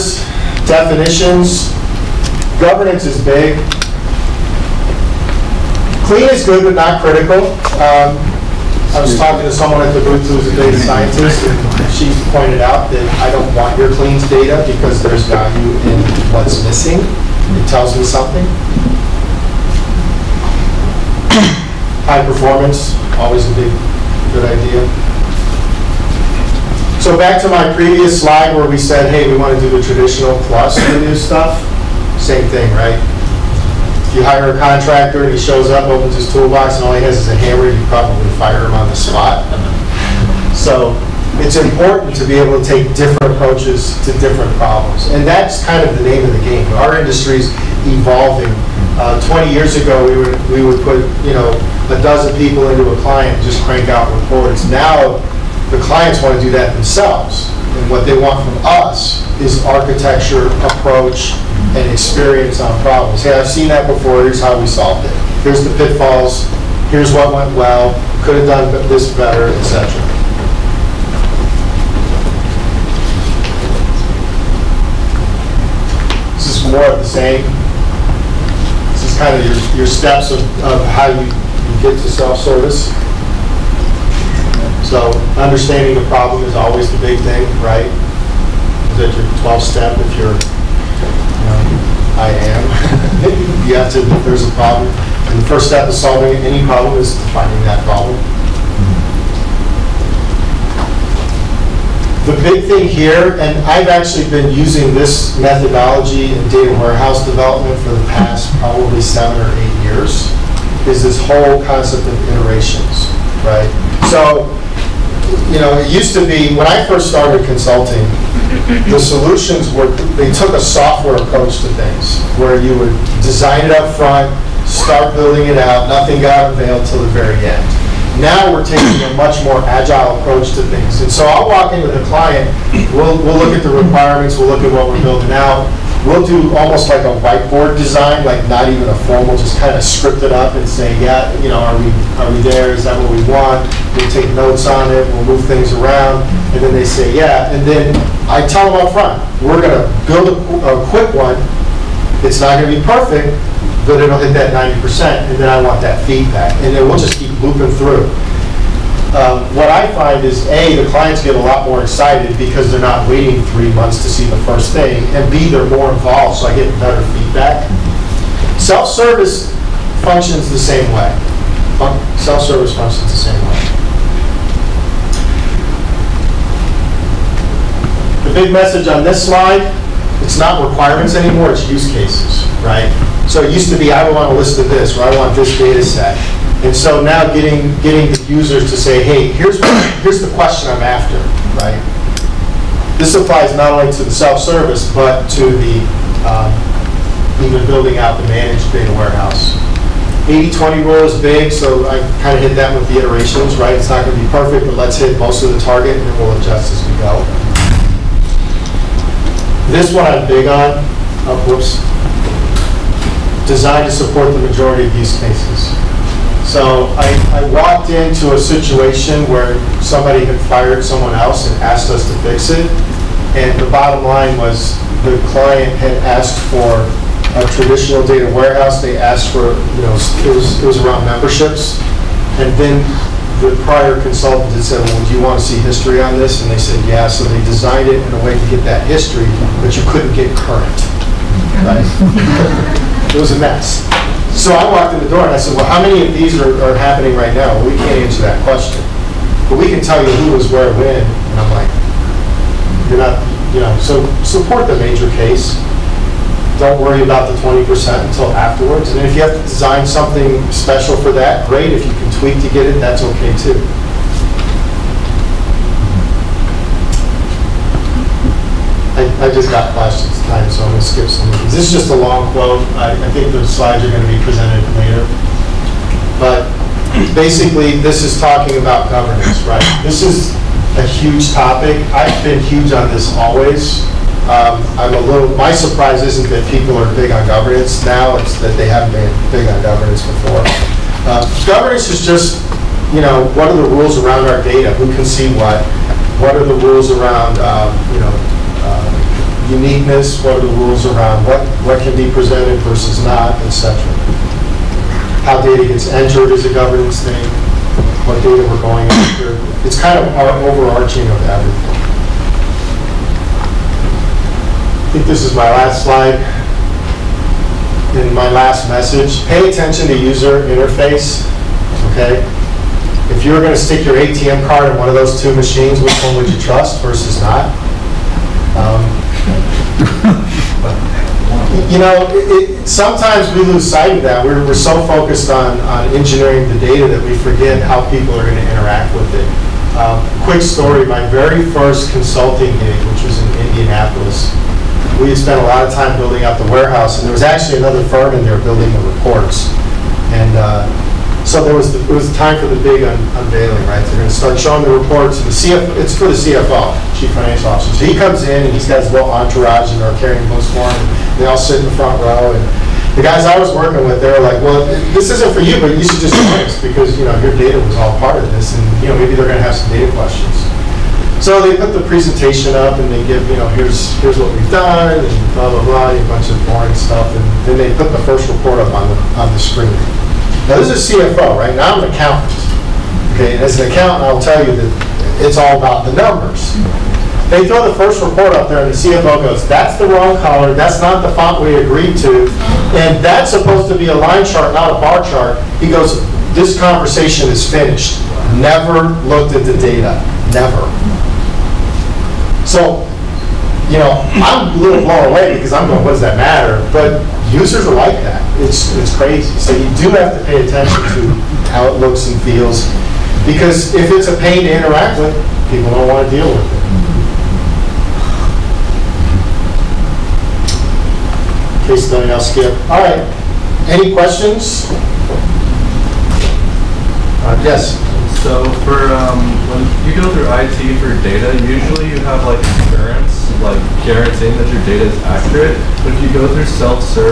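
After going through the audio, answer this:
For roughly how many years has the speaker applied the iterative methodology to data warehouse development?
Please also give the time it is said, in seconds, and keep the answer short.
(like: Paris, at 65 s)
seven or eight years, at 109 s.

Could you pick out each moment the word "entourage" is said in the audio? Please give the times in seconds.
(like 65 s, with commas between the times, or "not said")
359 s.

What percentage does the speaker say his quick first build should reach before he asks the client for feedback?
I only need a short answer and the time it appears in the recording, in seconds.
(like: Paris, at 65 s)
90%, at 154 s.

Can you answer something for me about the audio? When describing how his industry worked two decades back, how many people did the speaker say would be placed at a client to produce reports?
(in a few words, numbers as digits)
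a dozen.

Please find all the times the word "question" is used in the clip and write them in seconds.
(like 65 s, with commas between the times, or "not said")
190 s, 248 s, 369 s, 423 s.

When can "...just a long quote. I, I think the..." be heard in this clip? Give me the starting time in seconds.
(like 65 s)
271 s.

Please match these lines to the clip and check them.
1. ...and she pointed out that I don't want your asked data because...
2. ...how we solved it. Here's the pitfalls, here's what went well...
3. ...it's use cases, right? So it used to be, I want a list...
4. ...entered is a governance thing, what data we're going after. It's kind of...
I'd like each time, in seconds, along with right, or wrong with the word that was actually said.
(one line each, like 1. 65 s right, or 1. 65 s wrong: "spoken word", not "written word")
1. 11 s wrong: "cleaned", not "asked"
2. 64 s right
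3. 181 s right
4. 305 s right.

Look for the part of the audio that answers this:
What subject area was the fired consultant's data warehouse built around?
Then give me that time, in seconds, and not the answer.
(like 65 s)
231 s.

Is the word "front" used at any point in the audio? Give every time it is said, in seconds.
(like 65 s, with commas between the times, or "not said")
123 s, 148 s, 361 s.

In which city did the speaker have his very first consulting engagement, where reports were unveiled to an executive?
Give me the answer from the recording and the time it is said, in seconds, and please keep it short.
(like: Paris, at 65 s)
Indianapolis, at 343 s.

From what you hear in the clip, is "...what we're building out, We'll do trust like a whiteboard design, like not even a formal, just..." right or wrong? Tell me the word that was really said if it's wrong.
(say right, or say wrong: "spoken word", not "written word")
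wrong: "almost", not "trust".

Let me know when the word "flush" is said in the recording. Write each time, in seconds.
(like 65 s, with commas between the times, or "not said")
not said.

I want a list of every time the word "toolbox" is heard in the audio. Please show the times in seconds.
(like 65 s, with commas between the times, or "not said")
36 s.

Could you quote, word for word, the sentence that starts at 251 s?
And I'm like, you're not, you know, so support the major case.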